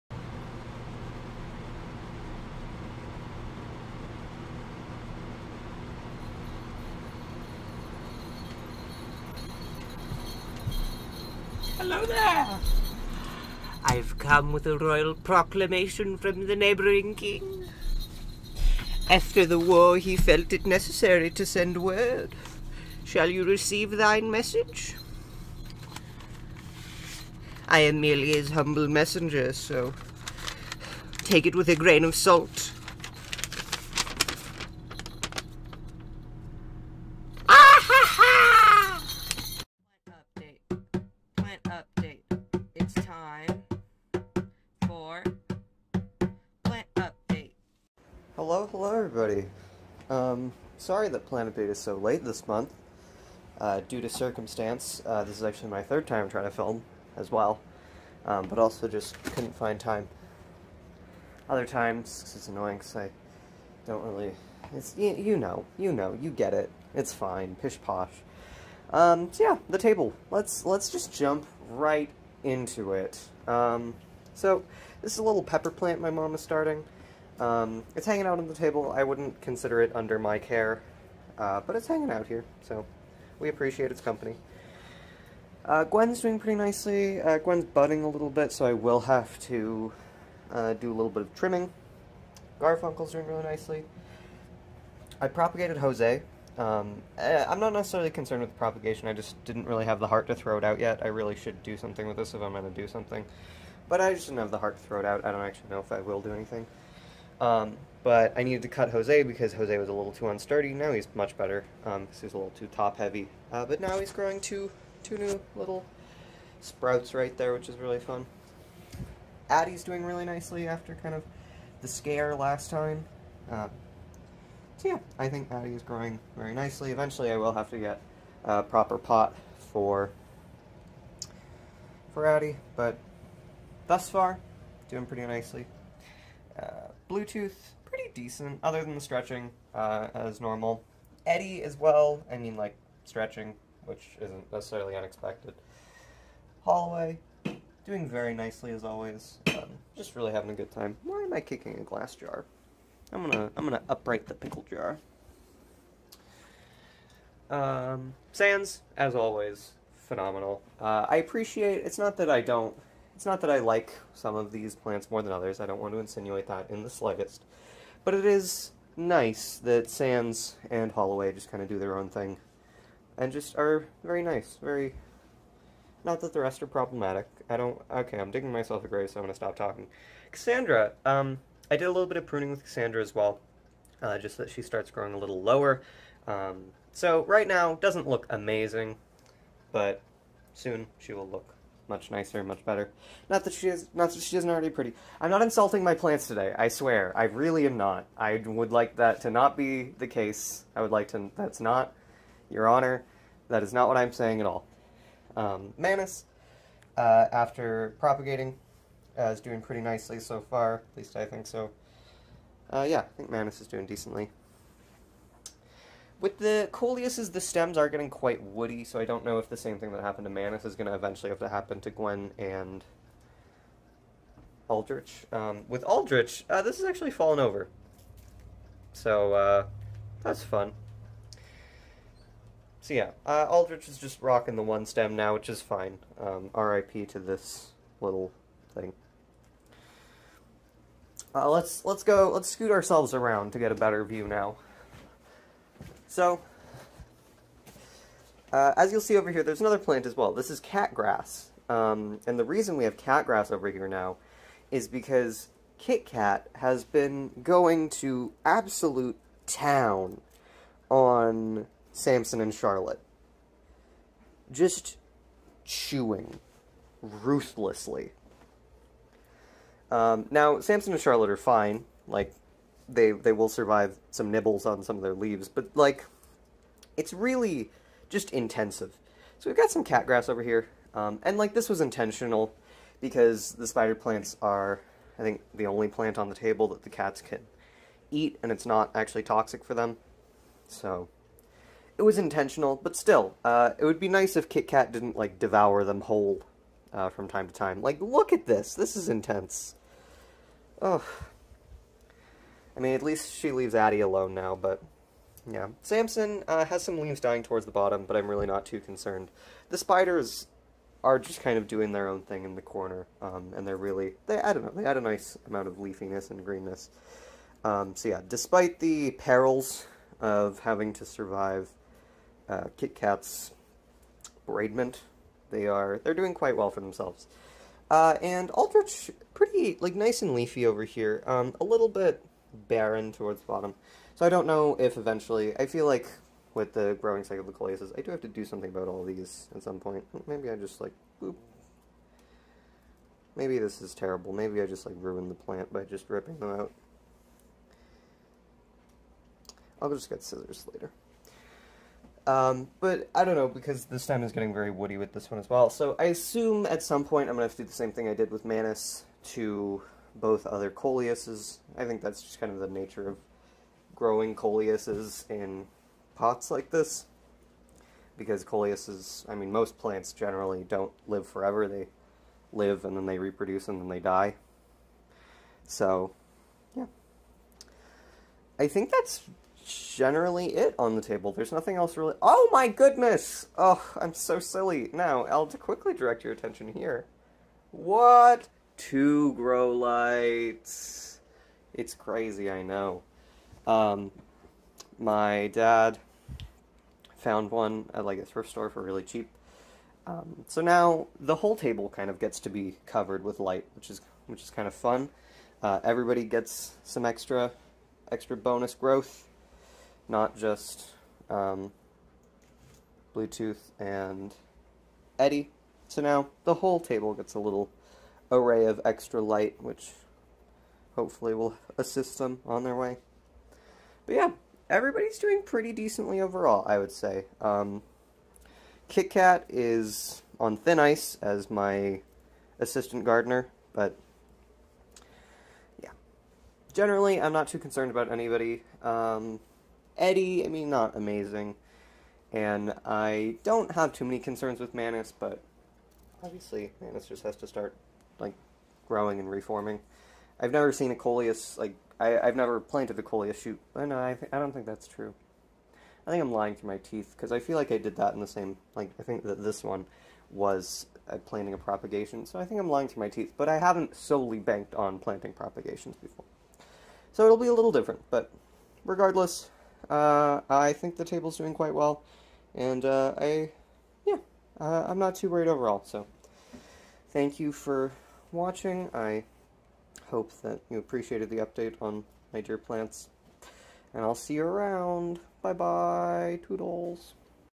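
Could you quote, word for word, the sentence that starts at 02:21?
Eddie as well, I mean, like, stretching, which isn't necessarily unexpected.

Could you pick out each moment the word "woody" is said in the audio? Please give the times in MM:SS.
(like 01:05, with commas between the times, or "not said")
03:38, 05:54.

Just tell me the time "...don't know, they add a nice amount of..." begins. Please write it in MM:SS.
05:14.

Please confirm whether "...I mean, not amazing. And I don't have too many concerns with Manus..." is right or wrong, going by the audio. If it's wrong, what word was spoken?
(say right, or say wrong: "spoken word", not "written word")
right.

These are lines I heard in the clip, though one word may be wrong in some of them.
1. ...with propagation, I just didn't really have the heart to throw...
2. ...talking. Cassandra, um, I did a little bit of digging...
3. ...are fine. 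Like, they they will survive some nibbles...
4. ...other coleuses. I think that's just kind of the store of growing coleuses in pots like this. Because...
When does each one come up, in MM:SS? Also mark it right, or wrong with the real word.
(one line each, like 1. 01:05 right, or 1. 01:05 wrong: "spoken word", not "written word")
1. 01:38 right
2. 02:59 wrong: "pruning", not "digging"
3. 04:31 right
4. 06:00 wrong: "nature", not "store".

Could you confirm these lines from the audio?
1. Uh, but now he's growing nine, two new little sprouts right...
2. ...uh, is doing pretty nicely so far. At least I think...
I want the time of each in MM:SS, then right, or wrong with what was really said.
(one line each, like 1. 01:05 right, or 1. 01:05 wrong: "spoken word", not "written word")
1. 01:53 wrong: "two", not "nine"
2. 03:29 right.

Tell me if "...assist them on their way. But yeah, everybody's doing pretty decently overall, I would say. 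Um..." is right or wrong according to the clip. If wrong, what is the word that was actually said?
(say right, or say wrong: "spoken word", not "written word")
right.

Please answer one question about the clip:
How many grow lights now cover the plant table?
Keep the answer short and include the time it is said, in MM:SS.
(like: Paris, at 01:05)
2, at 06:28.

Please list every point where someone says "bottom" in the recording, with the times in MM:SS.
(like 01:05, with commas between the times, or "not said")
05:07, 05:33.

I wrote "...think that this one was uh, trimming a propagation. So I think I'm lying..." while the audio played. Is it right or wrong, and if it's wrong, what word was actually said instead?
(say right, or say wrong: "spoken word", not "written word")
wrong: "planting", not "trimming".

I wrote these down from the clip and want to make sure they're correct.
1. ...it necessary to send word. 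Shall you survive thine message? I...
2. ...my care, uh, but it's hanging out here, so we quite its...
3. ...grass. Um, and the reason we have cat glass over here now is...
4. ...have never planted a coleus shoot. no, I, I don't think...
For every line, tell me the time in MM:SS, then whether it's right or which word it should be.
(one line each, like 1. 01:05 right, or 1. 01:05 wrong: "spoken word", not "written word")
1. 00:20 wrong: "receive", not "survive"
2. 01:20 wrong: "appreciate", not "quite"
3. 04:10 wrong: "grass", not "glass"
4. 07:32 right.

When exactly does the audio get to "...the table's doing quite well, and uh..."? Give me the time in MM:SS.
07:50.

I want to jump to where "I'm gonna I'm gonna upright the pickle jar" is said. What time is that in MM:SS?
02:33.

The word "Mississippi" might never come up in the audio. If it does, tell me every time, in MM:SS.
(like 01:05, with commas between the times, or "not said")
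not said.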